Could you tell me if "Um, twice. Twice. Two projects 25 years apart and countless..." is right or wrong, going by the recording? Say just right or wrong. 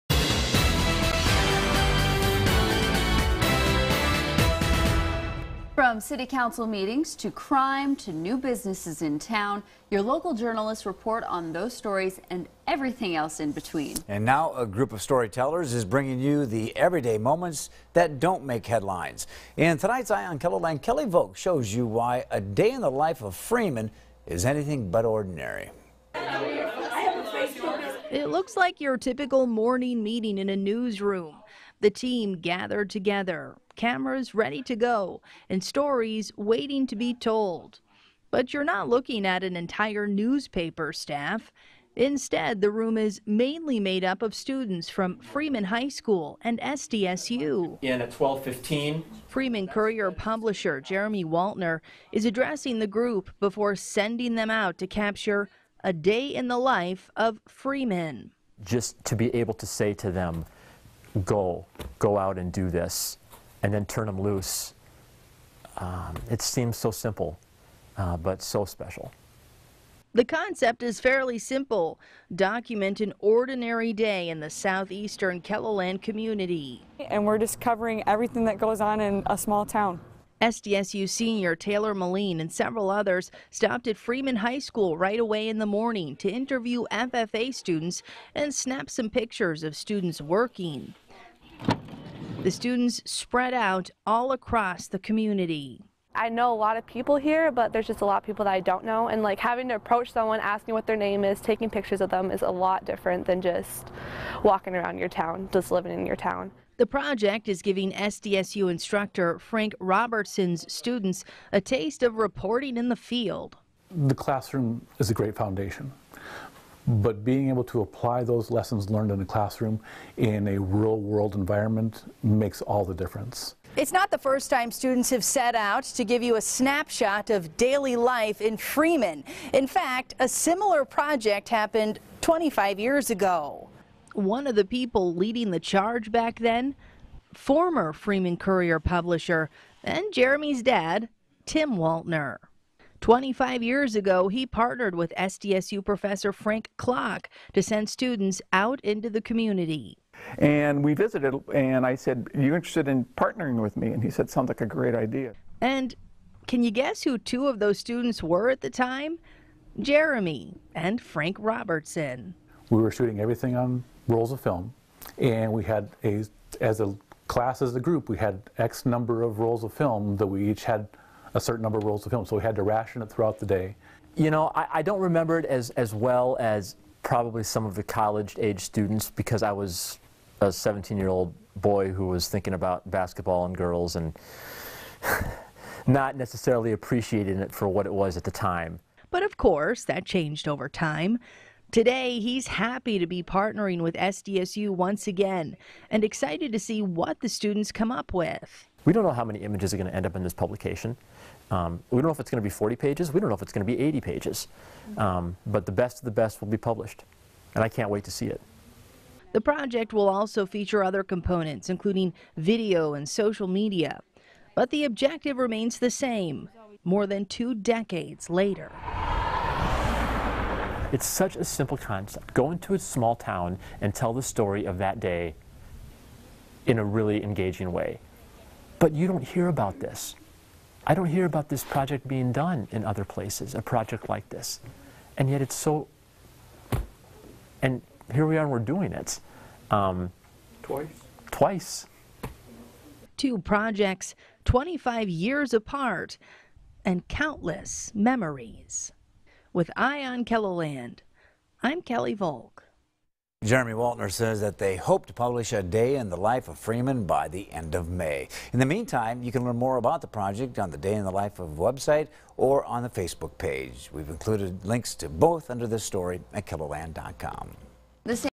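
right.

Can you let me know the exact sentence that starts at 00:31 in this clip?
The team gathered together, cameras ready to go, and stories waiting to be told.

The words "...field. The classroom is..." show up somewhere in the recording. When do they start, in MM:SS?
01:52.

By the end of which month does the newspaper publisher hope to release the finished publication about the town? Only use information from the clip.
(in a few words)
May.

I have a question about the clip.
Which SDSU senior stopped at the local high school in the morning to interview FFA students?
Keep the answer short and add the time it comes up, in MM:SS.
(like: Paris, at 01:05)
Taylor Moline, at 01:21.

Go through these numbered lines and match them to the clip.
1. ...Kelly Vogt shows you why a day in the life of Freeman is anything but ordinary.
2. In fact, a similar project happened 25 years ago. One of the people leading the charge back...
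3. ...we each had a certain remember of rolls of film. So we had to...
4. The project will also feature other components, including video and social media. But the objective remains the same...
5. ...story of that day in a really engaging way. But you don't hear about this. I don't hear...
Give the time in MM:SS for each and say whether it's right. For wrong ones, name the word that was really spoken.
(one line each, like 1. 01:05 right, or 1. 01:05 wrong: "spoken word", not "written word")
1. 00:20 right
2. 02:09 right
3. 02:50 wrong: "number", not "remember"
4. 03:29 right
5. 03:44 right.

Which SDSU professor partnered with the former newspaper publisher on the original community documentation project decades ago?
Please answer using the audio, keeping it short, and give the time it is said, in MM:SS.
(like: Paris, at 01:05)
Frank Clock, at 02:26.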